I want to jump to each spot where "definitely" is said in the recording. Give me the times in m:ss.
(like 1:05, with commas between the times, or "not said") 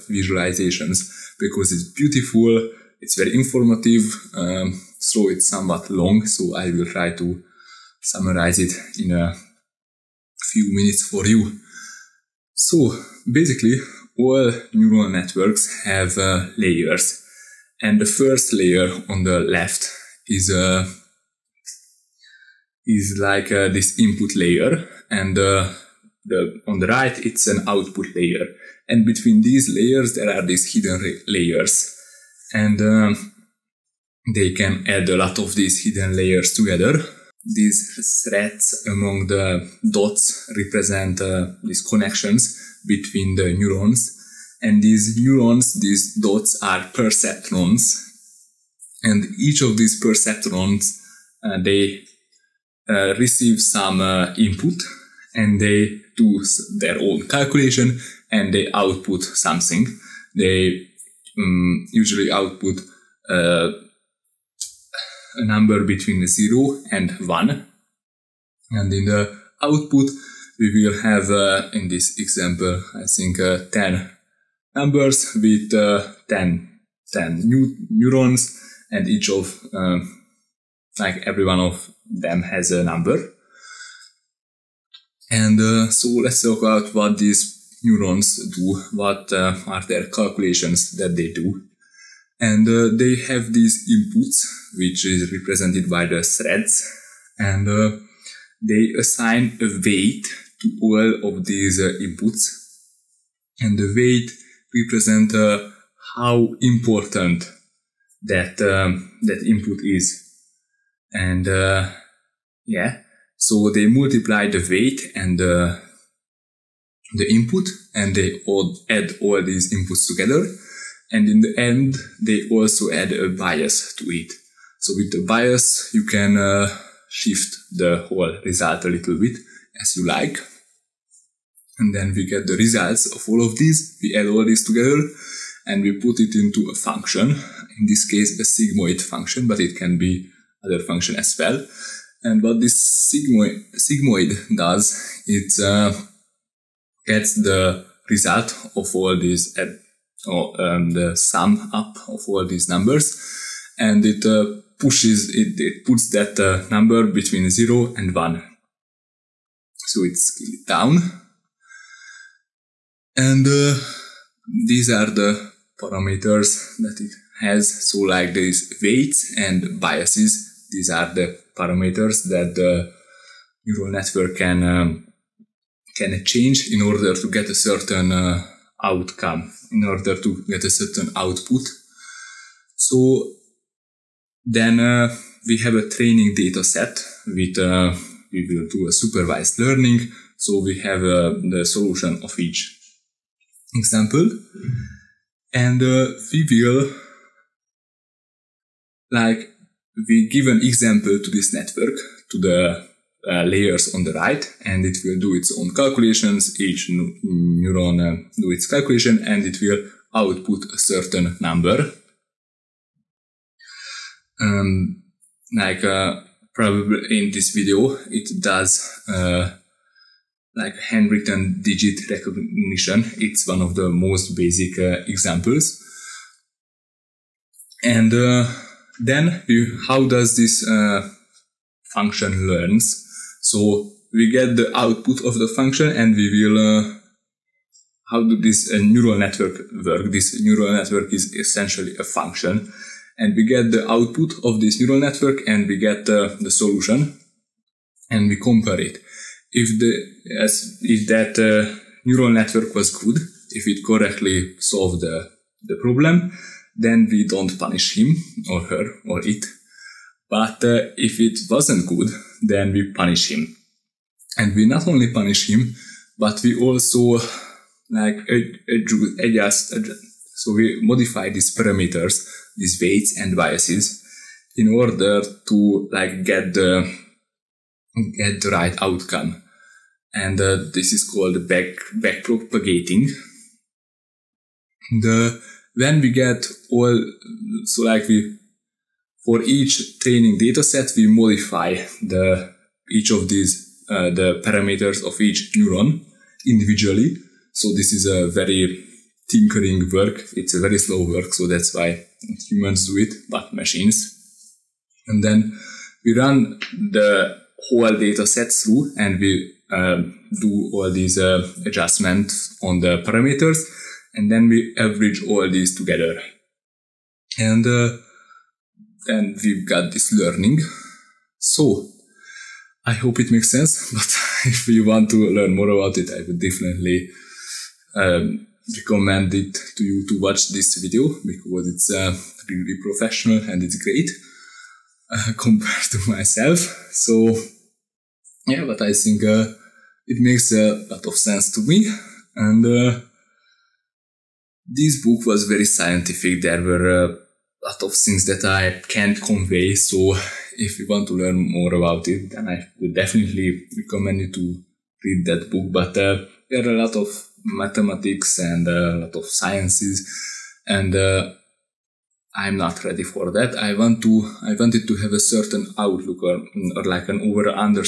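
5:26, 5:52.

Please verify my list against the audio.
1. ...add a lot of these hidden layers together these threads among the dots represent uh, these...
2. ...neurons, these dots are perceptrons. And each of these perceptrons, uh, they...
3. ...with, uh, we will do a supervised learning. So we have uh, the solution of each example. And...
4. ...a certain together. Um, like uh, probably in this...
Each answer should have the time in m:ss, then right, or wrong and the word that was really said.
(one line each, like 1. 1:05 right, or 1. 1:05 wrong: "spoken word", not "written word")
1. 0:34 right
2. 0:45 right
3. 3:07 right
4. 3:30 wrong: "number", not "together".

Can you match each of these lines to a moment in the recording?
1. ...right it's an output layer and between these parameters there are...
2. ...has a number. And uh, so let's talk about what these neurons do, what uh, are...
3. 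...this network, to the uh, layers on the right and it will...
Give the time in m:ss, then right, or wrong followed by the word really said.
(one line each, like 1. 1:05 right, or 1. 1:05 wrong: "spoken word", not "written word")
1. 0:26 wrong: "layers", not "parameters"
2. 1:22 right
3. 3:21 right.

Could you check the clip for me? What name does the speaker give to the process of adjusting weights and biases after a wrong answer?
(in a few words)
Back propagating.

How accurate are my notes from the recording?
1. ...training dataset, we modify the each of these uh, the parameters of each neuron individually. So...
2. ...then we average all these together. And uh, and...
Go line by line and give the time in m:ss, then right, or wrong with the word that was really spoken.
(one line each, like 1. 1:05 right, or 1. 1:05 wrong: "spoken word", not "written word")
1. 4:49 right
2. 5:14 right.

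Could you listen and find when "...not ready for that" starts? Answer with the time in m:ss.
6:02.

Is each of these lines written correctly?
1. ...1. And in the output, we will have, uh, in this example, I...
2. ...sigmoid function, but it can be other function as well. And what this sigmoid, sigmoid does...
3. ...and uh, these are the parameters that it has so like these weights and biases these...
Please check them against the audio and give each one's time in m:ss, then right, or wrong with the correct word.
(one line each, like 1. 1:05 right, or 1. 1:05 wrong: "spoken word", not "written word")
1. 1:07 right
2. 2:18 right
3. 2:43 right.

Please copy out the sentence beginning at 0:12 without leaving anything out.
So basically, all neural networks have uh, layers.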